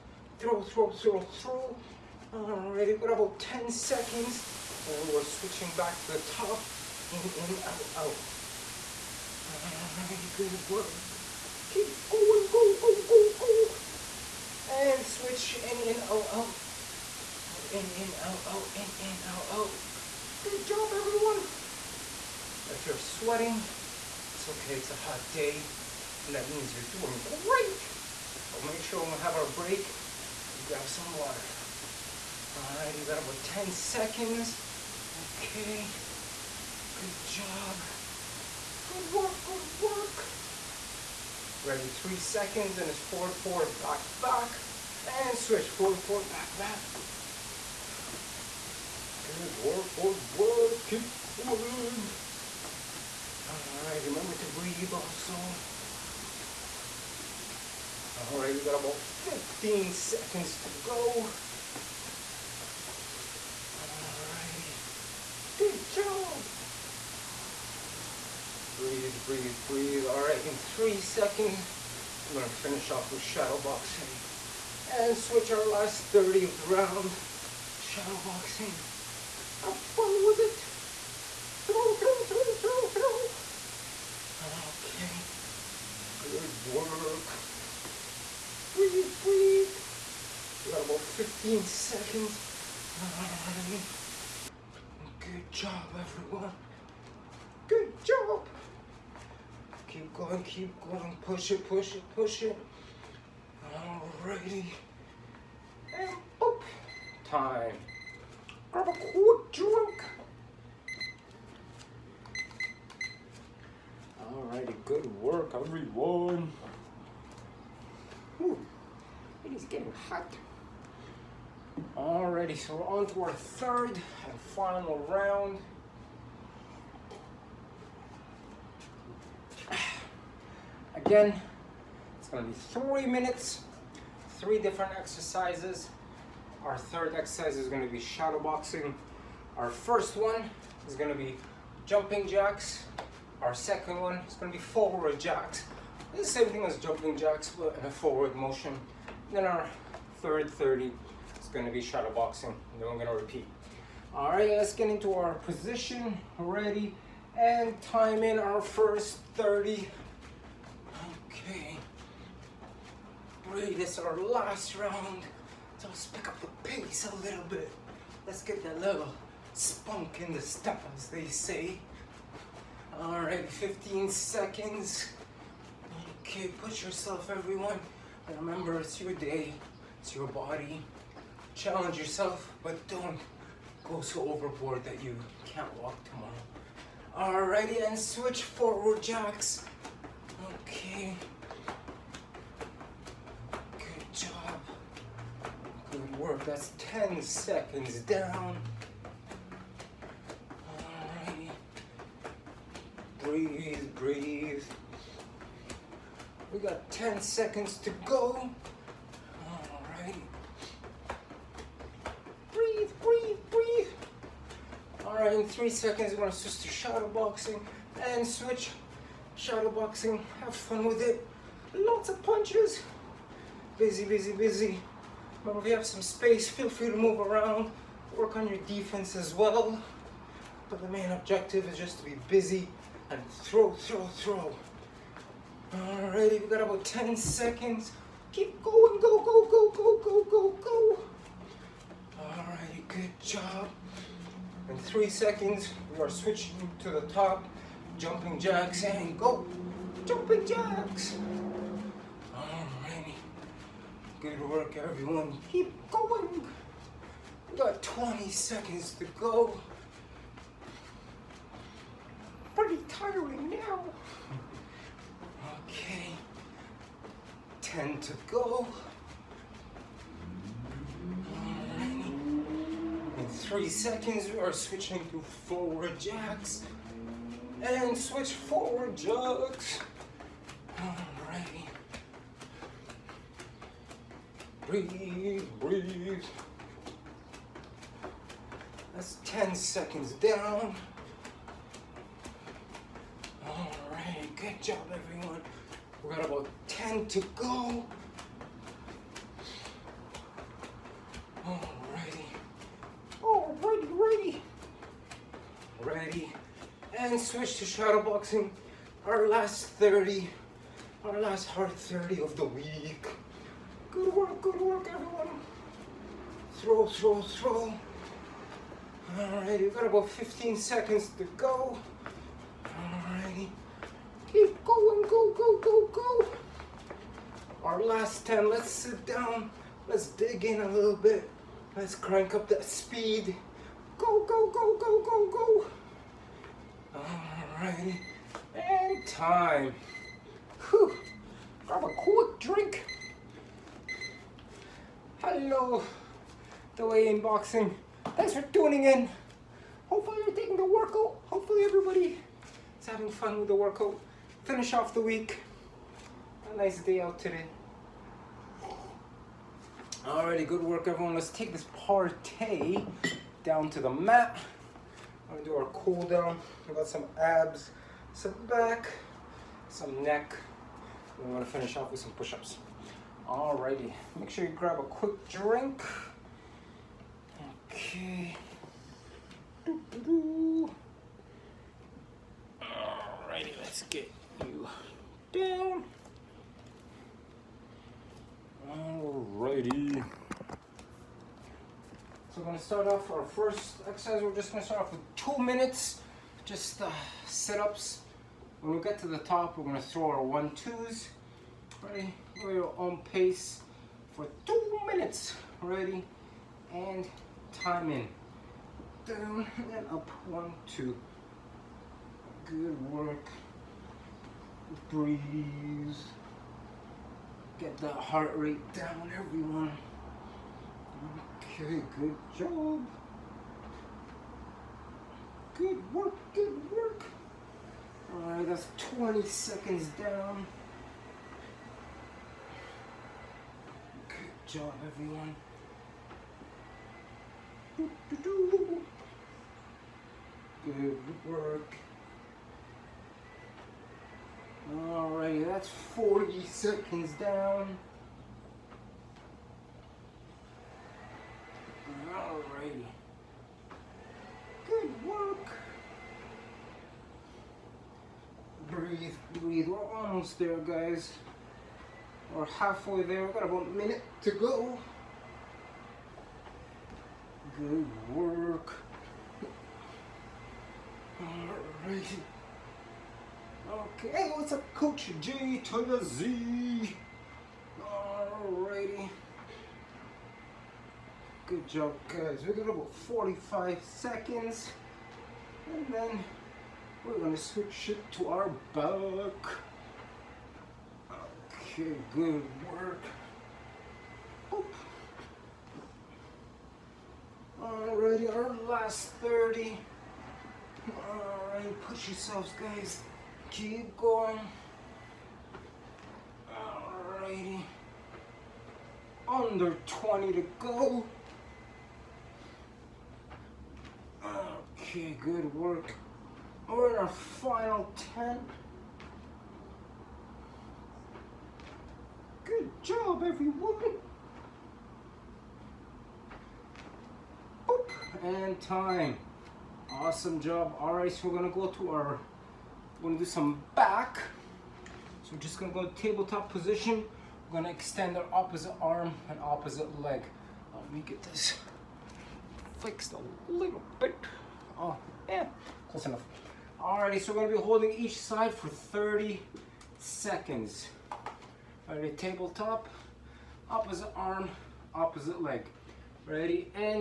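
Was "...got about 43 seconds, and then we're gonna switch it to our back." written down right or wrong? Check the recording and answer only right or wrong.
wrong.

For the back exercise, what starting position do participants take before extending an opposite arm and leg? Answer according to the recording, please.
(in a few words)
tabletop position.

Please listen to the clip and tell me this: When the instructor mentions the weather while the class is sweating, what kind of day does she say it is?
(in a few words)
a hot day.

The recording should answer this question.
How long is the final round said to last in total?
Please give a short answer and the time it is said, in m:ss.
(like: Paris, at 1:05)
3 minutes, at 2:12.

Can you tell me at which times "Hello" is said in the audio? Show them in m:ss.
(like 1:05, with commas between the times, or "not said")
5:45.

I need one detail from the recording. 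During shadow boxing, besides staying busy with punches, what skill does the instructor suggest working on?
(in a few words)
defense.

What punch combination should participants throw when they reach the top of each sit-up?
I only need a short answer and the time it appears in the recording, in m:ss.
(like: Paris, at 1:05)
one twos, at 6:40.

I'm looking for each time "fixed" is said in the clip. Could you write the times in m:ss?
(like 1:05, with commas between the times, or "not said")
9:02.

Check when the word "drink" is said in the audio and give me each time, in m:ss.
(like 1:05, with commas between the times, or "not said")
5:42, 6:15.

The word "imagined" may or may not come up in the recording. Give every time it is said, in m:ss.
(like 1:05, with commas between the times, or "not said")
not said.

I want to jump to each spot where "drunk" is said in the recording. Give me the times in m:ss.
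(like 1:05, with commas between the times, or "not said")
1:49.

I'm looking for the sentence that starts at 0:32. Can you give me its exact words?
All right, you got about 10 seconds.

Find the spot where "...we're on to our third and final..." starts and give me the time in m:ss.
2:02.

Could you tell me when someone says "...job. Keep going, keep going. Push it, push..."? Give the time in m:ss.
1:38.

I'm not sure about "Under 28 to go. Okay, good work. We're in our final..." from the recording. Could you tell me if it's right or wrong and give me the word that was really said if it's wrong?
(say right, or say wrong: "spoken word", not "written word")
wrong: "20", not "28".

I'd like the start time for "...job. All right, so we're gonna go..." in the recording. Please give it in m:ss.
8:50.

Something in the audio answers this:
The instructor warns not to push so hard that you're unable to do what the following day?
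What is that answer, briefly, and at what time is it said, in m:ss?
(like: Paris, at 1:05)
walk, at 3:05.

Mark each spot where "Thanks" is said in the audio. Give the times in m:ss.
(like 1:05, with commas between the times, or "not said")
5:48.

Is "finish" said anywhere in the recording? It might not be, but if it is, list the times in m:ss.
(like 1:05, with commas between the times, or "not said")
1:12, 5:54, 6:11.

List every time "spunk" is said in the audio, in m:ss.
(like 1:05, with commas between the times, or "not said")
2:49.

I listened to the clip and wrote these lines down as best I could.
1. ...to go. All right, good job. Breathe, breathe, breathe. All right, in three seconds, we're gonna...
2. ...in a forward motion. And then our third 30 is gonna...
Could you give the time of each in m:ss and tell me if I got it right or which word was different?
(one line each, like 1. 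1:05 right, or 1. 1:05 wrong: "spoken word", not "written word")
1. 1:00 right
2. 2:27 right.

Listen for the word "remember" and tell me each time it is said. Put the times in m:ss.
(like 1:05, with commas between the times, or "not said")
0:54, 2:58.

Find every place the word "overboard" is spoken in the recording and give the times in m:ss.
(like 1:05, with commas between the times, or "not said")
3:04.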